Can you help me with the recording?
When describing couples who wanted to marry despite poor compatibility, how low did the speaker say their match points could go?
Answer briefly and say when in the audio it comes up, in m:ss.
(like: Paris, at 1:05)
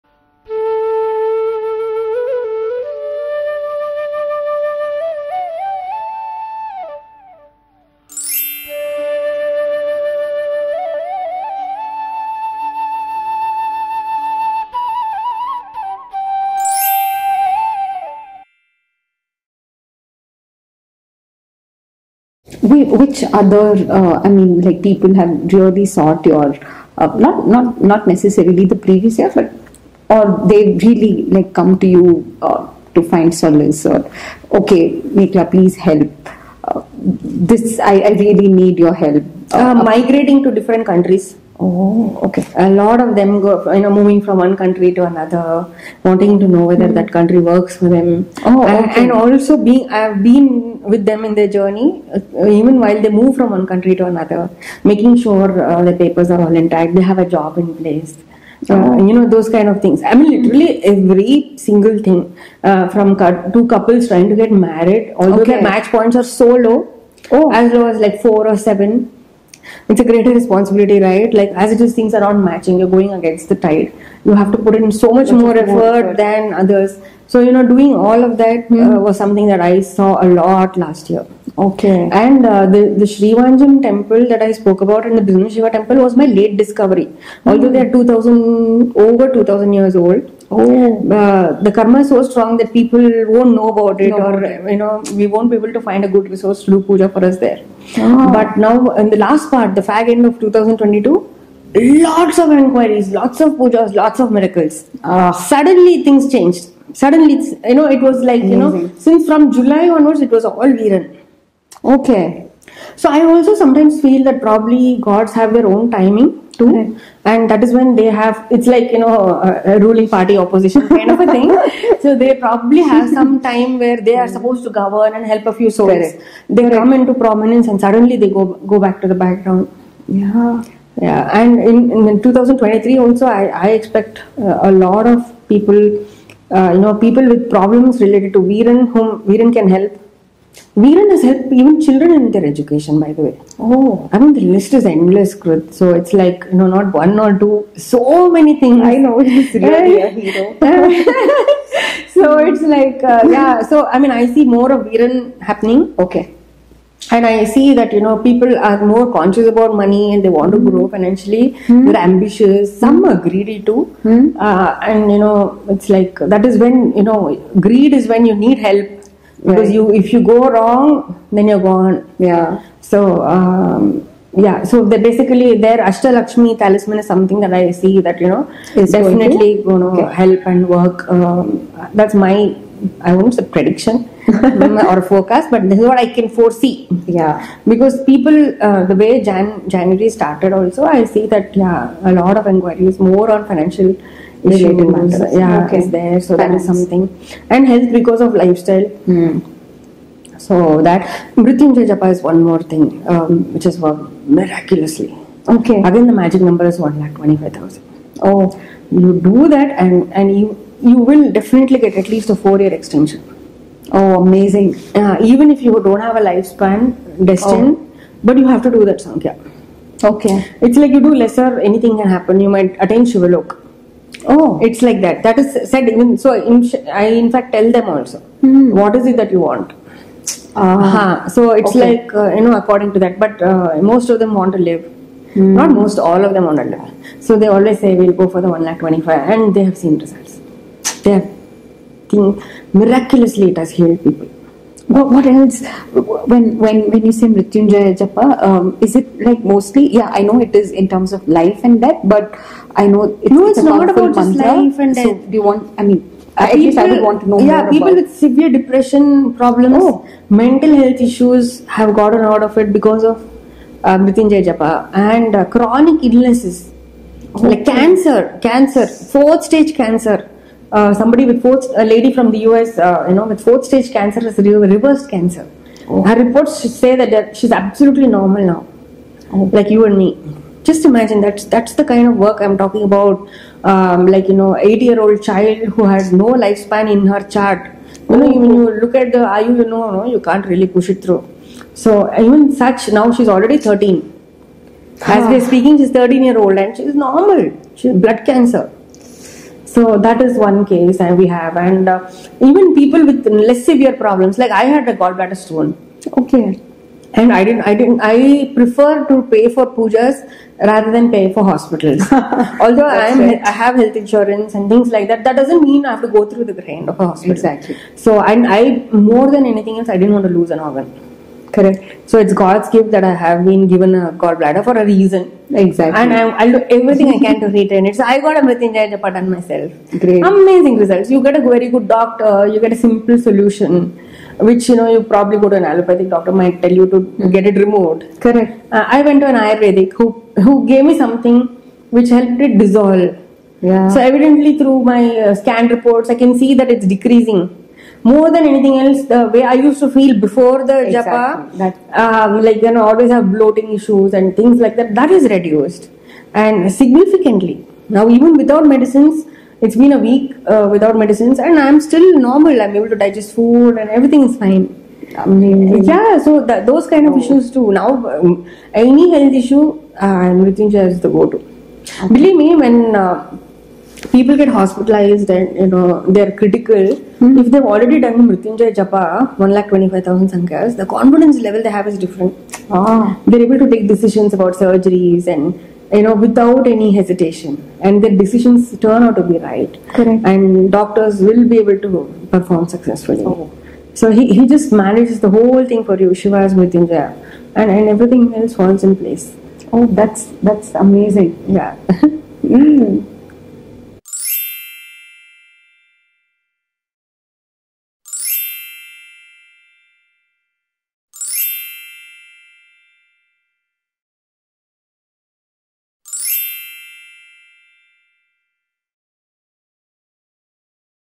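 4 or 7, at 1:08.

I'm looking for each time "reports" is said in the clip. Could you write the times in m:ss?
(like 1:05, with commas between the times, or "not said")
4:36, 5:45.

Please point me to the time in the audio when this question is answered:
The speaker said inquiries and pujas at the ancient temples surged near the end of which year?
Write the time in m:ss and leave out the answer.
1:40.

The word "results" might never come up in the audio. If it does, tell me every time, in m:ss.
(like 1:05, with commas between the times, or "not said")
3:59, 5:30.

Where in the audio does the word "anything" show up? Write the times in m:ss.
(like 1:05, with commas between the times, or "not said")
3:41, 5:19, 5:48.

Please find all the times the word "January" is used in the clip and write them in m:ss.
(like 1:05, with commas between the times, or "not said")
3:09.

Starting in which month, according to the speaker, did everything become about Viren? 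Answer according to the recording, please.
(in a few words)
July.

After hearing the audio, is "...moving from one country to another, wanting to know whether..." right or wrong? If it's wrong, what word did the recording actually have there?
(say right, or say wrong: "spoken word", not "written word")
right.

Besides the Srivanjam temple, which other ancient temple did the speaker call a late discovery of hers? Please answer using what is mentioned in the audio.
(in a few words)
Bhima Shiva temple.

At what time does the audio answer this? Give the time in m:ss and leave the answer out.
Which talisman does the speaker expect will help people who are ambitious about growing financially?
2:55.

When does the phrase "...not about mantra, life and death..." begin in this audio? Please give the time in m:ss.
4:13.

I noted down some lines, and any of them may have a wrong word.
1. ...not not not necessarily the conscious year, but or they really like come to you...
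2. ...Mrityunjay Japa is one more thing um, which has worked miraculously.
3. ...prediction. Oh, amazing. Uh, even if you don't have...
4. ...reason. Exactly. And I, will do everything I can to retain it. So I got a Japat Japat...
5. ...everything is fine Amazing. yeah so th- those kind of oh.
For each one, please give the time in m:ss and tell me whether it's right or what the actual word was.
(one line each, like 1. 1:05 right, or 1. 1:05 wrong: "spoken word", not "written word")
1. 0:27 wrong: "previous", not "conscious"
2. 3:21 right
3. 3:32 wrong: "extension", not "prediction"
4. 5:24 wrong: "Mrityunjaya", not "Japat"
5. 6:03 right.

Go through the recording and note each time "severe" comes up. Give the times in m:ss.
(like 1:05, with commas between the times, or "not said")
4:18, 5:03.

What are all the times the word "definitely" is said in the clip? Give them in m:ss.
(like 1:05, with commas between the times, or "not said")
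2:58, 3:31.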